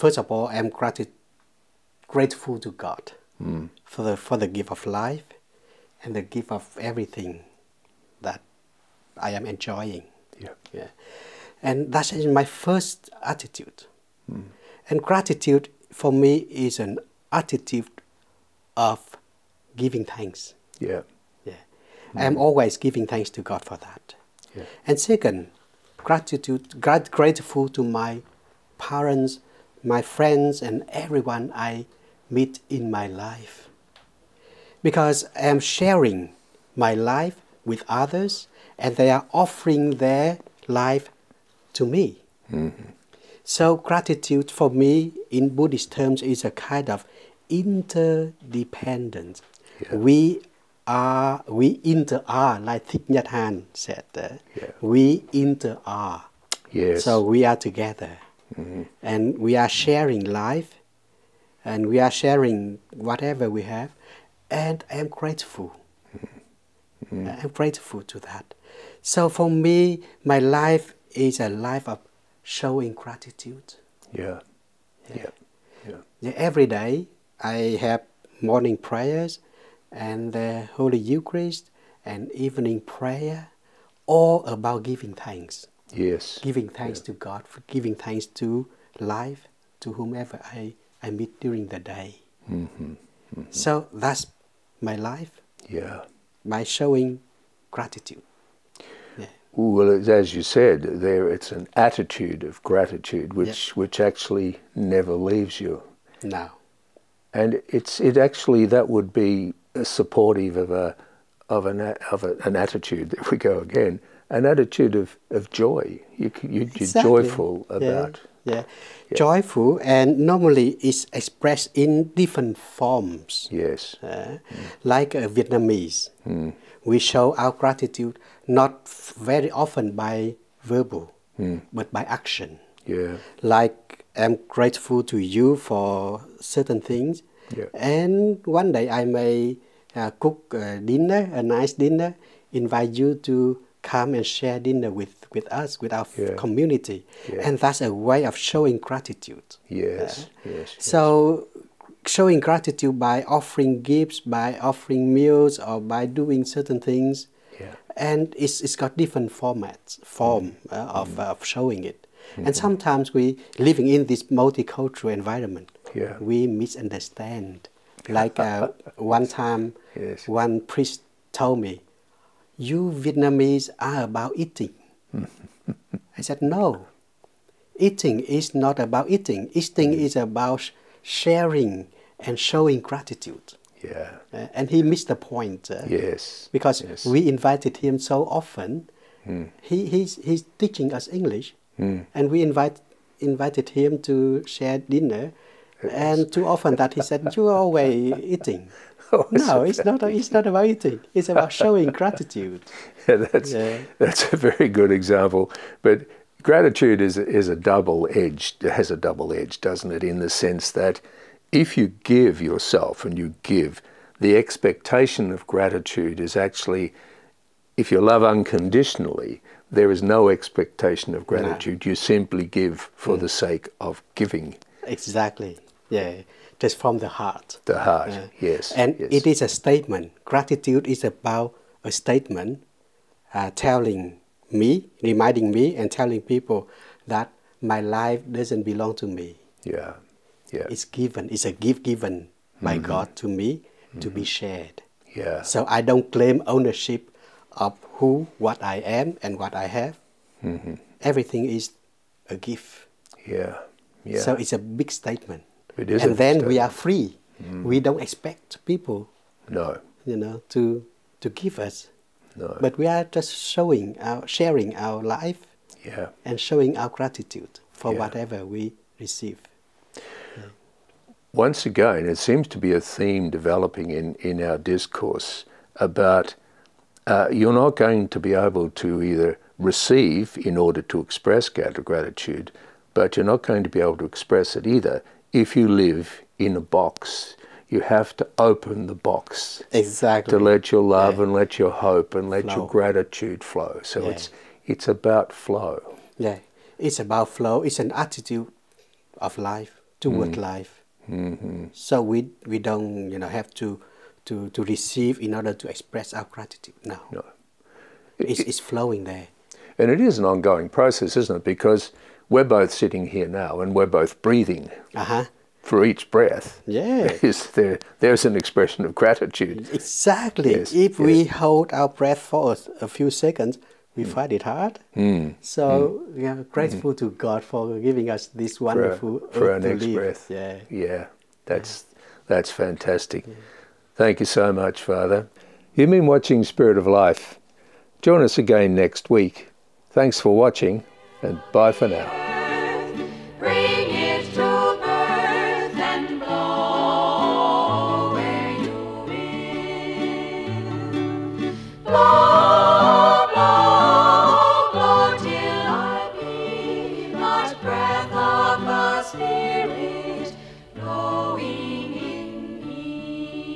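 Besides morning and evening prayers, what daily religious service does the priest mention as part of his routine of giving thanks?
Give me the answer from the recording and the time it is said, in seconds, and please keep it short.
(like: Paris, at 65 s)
Holy Eucharist, at 80 s.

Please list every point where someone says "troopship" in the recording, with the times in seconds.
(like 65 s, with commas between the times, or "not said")
not said.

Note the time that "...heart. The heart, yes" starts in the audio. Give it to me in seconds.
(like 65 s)
227 s.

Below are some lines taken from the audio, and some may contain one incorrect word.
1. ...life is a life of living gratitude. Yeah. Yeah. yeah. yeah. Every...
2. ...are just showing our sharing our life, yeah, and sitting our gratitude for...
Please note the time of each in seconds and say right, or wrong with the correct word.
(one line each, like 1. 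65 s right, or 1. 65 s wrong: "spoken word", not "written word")
1. 70 s wrong: "showing", not "living"
2. 262 s wrong: "showing", not "sitting".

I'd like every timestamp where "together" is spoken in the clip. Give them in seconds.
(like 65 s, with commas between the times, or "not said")
57 s.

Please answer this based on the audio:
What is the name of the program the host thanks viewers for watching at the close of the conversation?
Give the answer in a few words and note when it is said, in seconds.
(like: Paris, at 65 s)
Spirit of Life, at 336 s.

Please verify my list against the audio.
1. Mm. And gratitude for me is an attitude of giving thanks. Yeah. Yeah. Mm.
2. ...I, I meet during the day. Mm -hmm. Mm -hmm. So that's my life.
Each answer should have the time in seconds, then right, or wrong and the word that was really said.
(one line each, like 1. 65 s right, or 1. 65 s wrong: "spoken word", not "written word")
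1. 14 s right
2. 90 s right.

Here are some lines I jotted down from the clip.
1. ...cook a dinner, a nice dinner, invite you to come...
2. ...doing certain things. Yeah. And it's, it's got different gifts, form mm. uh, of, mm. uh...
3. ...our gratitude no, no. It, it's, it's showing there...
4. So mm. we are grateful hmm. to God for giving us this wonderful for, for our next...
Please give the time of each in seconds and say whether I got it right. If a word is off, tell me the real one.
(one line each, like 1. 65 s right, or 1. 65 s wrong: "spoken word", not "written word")
1. 140 s right
2. 156 s wrong: "formats", not "gifts"
3. 306 s wrong: "flowing", not "showing"
4. 325 s right.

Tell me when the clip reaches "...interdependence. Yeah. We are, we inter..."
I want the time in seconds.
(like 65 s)
47 s.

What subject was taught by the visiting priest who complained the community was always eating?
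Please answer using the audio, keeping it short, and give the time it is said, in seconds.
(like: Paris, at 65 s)
English, at 191 s.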